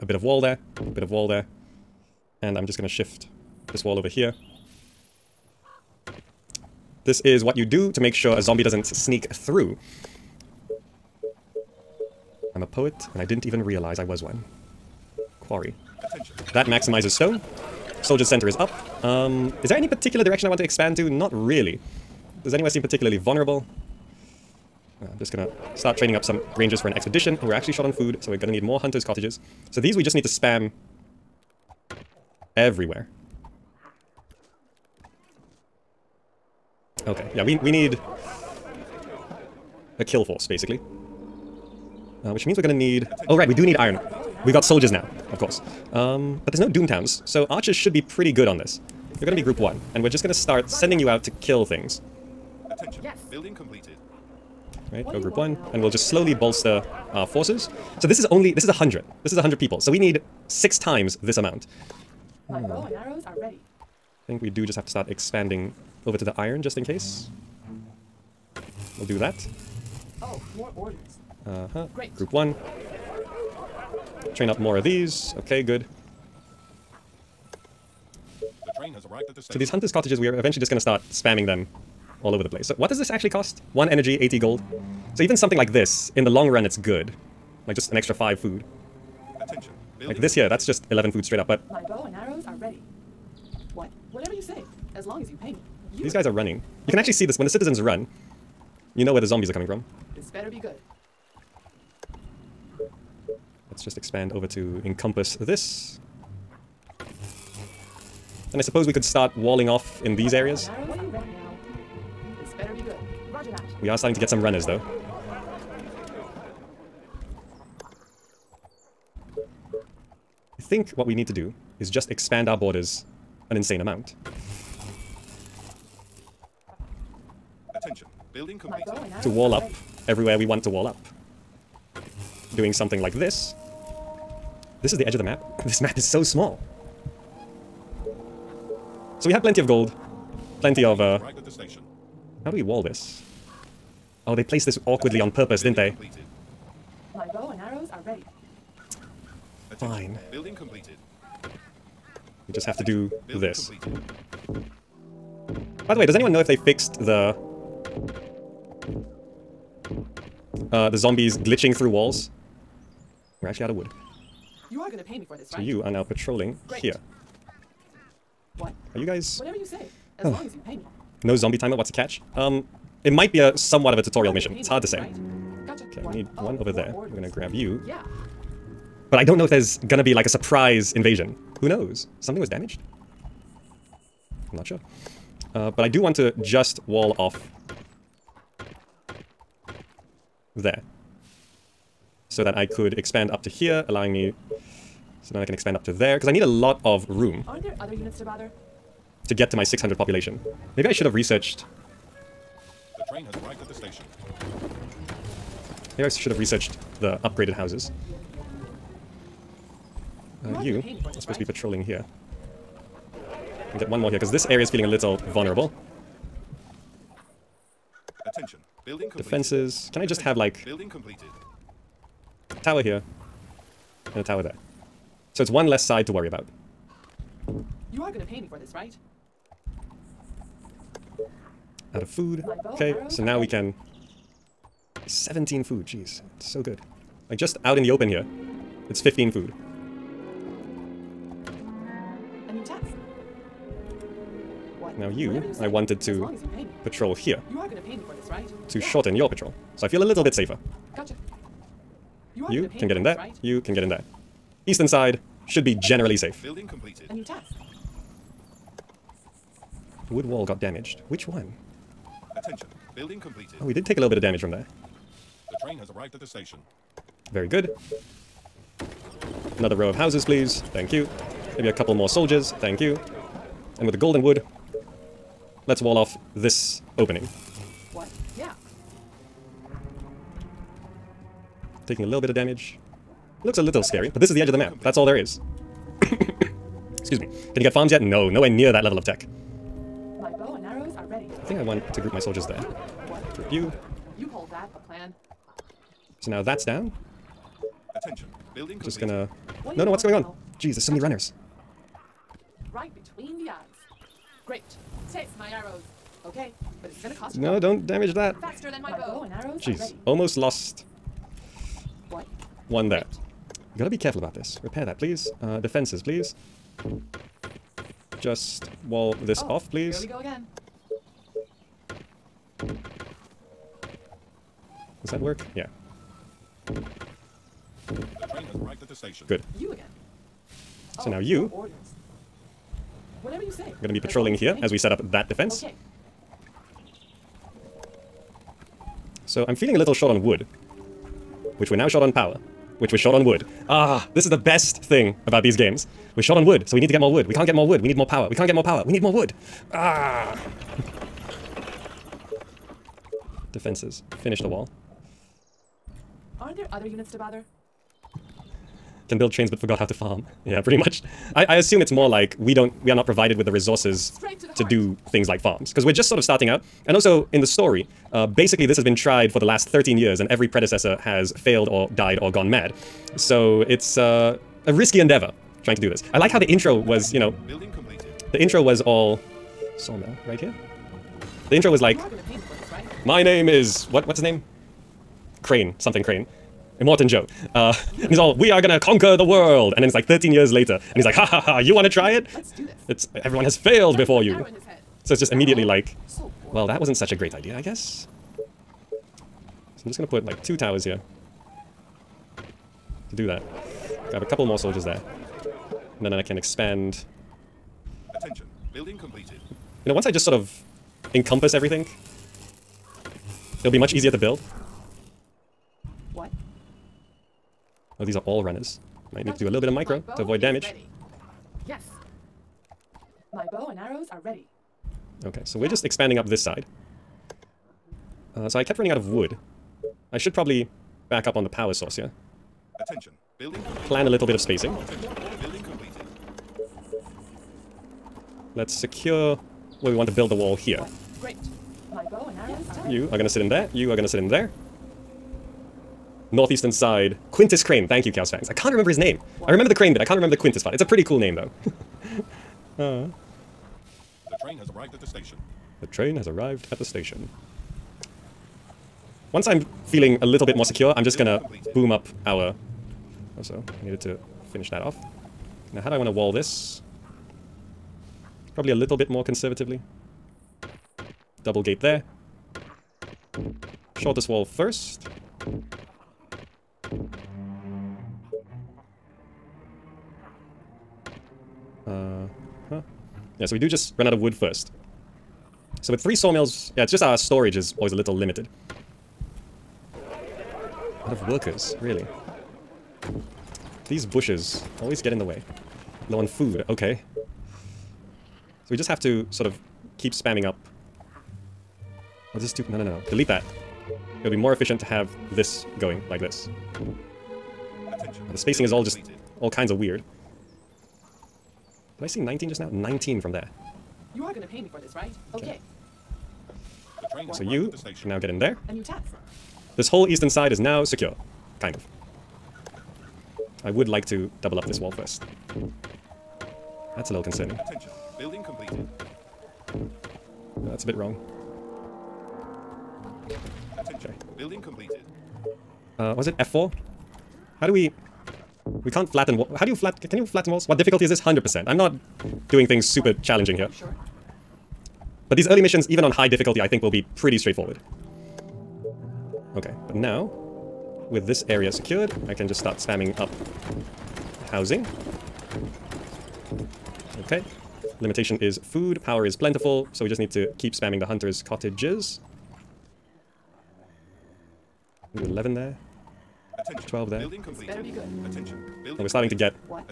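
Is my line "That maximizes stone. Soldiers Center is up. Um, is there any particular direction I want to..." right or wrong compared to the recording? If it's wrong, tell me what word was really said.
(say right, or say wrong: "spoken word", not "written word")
right.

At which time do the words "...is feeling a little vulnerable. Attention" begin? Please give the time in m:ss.
3:34.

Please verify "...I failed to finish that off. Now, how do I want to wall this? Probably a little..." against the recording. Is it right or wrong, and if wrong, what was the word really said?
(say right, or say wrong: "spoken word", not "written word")
wrong: "needed", not "failed".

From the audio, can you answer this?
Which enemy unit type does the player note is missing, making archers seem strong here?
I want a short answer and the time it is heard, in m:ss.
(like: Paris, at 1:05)
doom towns, at 0:46.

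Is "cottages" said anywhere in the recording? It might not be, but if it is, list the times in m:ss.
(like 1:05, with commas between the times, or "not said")
0:29, 1:19, 9:21.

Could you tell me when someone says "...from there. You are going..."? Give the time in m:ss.
8:33.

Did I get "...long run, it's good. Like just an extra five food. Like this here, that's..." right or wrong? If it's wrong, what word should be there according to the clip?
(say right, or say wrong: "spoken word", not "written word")
right.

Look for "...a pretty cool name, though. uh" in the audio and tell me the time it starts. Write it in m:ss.
7:30.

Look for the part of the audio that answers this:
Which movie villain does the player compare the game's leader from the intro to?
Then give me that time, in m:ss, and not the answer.
6:26.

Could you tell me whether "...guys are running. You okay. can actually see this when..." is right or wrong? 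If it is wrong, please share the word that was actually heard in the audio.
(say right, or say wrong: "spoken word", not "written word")
right.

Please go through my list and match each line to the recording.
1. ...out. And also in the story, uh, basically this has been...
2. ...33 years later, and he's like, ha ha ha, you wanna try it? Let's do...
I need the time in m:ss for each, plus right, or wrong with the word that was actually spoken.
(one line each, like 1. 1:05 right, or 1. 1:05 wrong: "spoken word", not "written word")
1. 6:06 right
2. 6:30 wrong: "13", not "33".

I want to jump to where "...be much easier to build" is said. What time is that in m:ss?
6:53.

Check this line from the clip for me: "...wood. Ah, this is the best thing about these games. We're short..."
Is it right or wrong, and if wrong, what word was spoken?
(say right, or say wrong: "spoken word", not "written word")
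right.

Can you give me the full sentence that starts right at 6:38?
So I'm just gonna put like two towers here.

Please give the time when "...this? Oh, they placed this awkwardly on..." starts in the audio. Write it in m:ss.
2:22.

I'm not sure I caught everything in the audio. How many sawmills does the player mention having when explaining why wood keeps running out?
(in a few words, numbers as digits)
3.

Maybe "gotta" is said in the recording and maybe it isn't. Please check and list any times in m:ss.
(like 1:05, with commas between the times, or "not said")
5:13.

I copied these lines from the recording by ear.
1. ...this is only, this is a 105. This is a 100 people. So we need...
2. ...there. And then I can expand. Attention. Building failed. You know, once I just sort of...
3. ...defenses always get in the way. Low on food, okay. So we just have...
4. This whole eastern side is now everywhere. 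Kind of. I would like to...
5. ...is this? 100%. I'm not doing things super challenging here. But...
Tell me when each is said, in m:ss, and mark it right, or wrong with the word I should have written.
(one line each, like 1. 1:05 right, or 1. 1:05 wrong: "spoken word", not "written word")
1. 0:58 wrong: "100", not "105"
2. 6:44 wrong: "completed", not "failed"
3. 8:14 wrong: "bushes", not "defenses"
4. 8:39 wrong: "secure", not "everywhere"
5. 9:01 right.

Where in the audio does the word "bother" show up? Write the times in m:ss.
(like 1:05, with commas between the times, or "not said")
3:18, 5:57.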